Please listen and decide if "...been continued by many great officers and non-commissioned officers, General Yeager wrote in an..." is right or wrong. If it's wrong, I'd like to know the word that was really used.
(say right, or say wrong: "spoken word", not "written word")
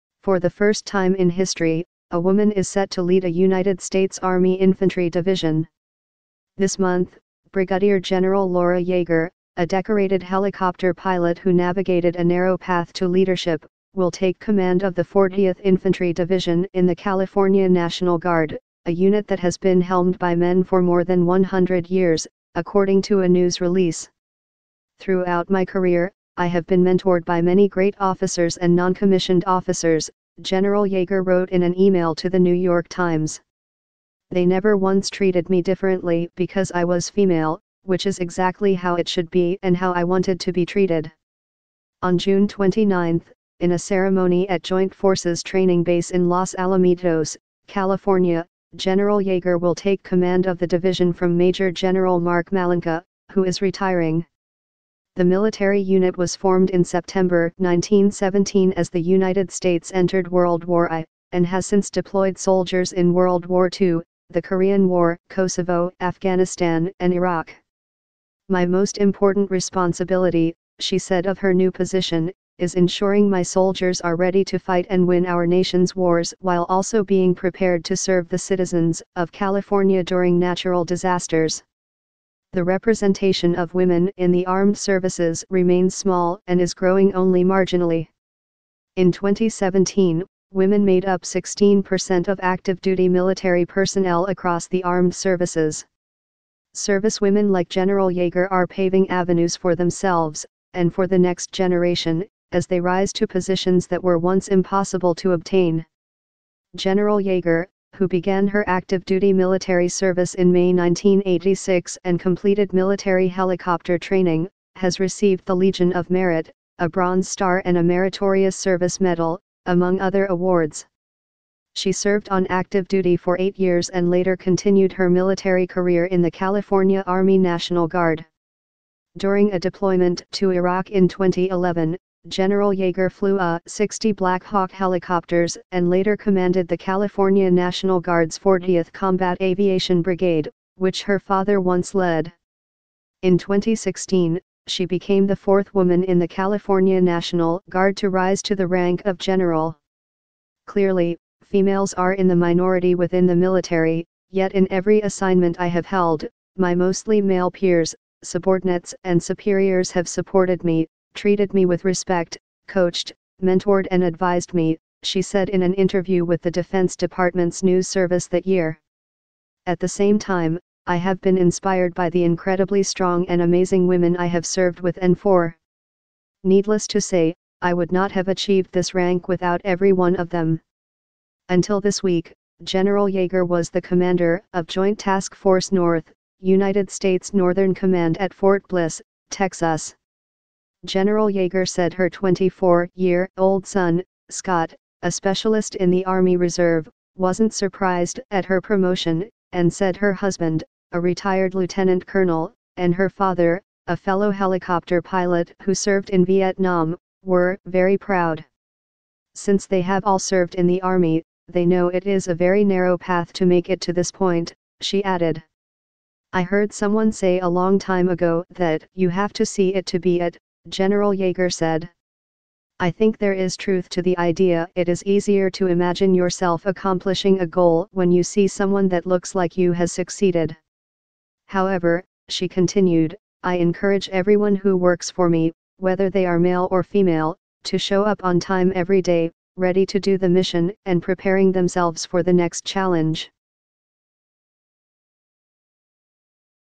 wrong: "mentored", not "continued".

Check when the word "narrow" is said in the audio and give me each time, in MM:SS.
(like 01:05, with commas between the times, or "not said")
00:12, 03:32.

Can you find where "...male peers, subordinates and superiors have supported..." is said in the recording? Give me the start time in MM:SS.
02:37.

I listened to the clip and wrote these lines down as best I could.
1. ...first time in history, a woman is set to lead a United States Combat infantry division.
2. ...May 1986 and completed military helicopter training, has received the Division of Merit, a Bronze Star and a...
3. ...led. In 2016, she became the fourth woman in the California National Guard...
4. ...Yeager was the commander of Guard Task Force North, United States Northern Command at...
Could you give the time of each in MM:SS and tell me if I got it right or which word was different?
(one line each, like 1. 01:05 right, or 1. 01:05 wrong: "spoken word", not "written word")
1. 00:00 wrong: "Army", not "Combat"
2. 01:50 wrong: "Legion", not "Division"
3. 02:21 right
4. 03:03 wrong: "Joint", not "Guard".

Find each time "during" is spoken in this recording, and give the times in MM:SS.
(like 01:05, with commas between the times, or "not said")
01:20, 02:09.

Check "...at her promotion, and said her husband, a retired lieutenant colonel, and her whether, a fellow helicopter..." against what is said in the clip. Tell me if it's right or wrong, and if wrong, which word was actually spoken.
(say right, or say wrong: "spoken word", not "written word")
wrong: "father", not "whether".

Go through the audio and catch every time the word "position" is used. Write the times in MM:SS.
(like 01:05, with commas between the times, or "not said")
01:11, 01:43.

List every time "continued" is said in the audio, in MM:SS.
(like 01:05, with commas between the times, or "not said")
02:04, 03:52.